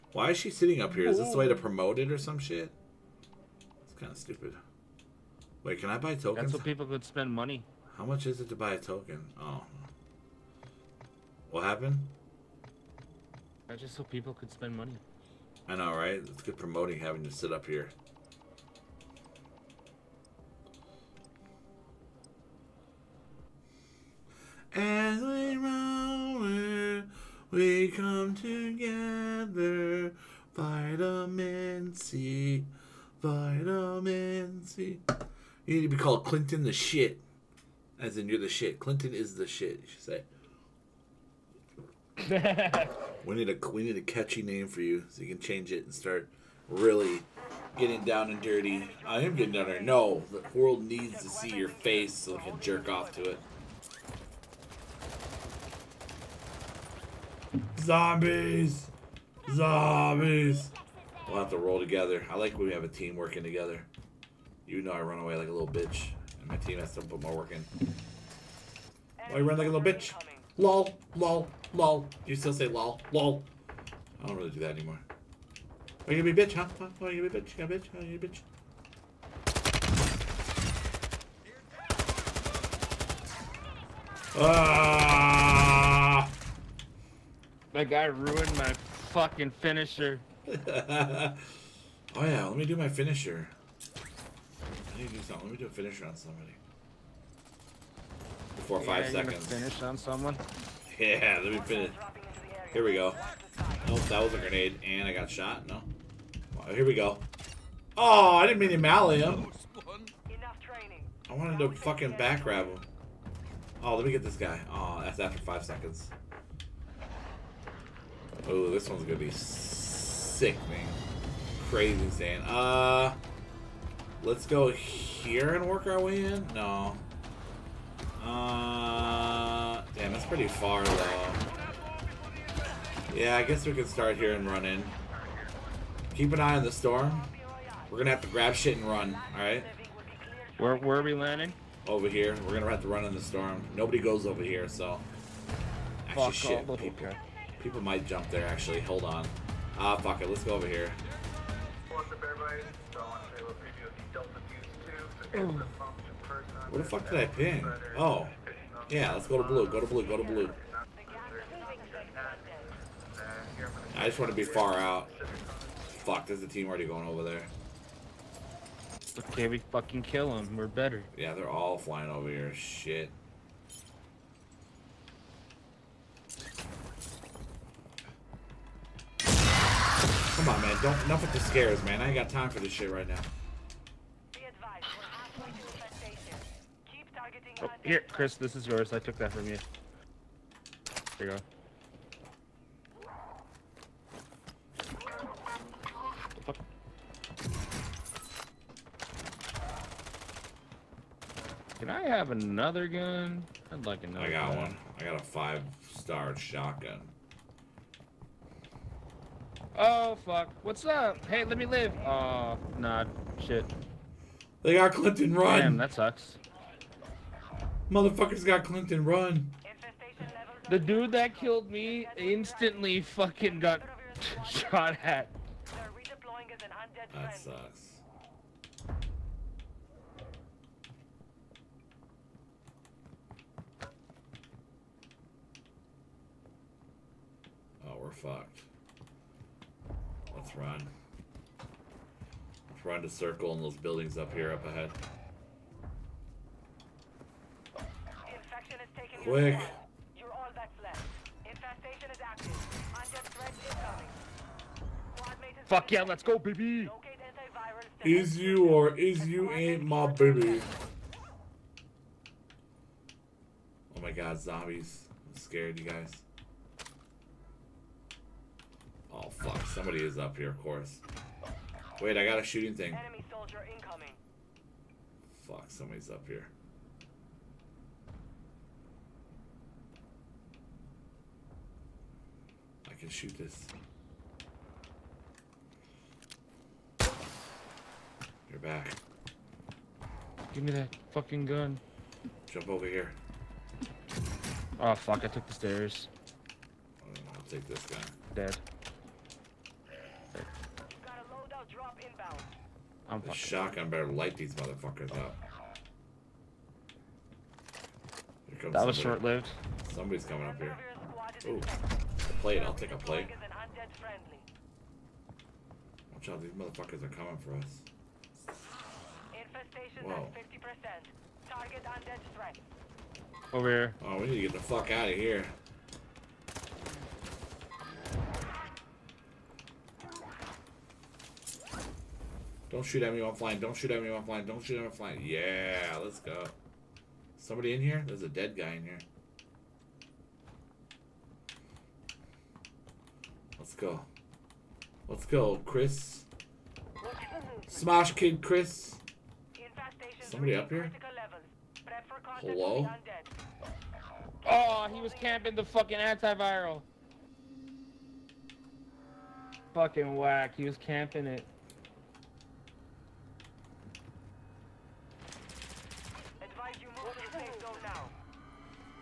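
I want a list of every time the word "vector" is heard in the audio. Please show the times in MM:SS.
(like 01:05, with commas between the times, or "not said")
not said.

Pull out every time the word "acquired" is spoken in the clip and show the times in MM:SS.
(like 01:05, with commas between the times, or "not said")
not said.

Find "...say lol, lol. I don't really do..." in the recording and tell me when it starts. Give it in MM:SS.
01:12.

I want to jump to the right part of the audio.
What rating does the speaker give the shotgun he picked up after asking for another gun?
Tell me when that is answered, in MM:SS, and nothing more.
03:25.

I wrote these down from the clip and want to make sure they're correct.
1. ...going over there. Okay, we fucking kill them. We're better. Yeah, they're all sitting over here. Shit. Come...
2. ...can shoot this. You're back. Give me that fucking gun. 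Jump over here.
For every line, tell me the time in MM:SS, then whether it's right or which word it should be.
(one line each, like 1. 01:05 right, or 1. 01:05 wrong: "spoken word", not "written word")
1. 02:46 wrong: "flying", not "sitting"
2. 04:42 right.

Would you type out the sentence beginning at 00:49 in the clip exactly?
No, the world needs to see your face so they can jerk off to it.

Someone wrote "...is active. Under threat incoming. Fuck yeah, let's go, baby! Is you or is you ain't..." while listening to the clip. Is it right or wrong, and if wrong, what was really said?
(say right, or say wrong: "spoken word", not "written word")
right.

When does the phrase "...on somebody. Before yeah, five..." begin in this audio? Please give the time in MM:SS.
01:36.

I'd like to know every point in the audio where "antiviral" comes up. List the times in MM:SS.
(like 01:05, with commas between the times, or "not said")
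05:55.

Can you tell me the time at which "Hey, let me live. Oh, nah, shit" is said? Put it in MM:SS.
03:31.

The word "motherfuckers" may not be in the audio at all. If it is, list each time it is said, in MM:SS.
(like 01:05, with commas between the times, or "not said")
03:37, 05:04, 05:16.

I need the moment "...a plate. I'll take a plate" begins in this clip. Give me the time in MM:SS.
05:11.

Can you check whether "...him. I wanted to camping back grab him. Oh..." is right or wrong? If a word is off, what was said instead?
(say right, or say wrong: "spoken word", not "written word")
wrong: "fucking", not "camping".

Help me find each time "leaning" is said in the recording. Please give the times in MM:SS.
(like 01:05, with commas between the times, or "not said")
not said.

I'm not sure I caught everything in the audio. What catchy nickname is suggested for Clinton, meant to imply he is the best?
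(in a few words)
Clinton the shit.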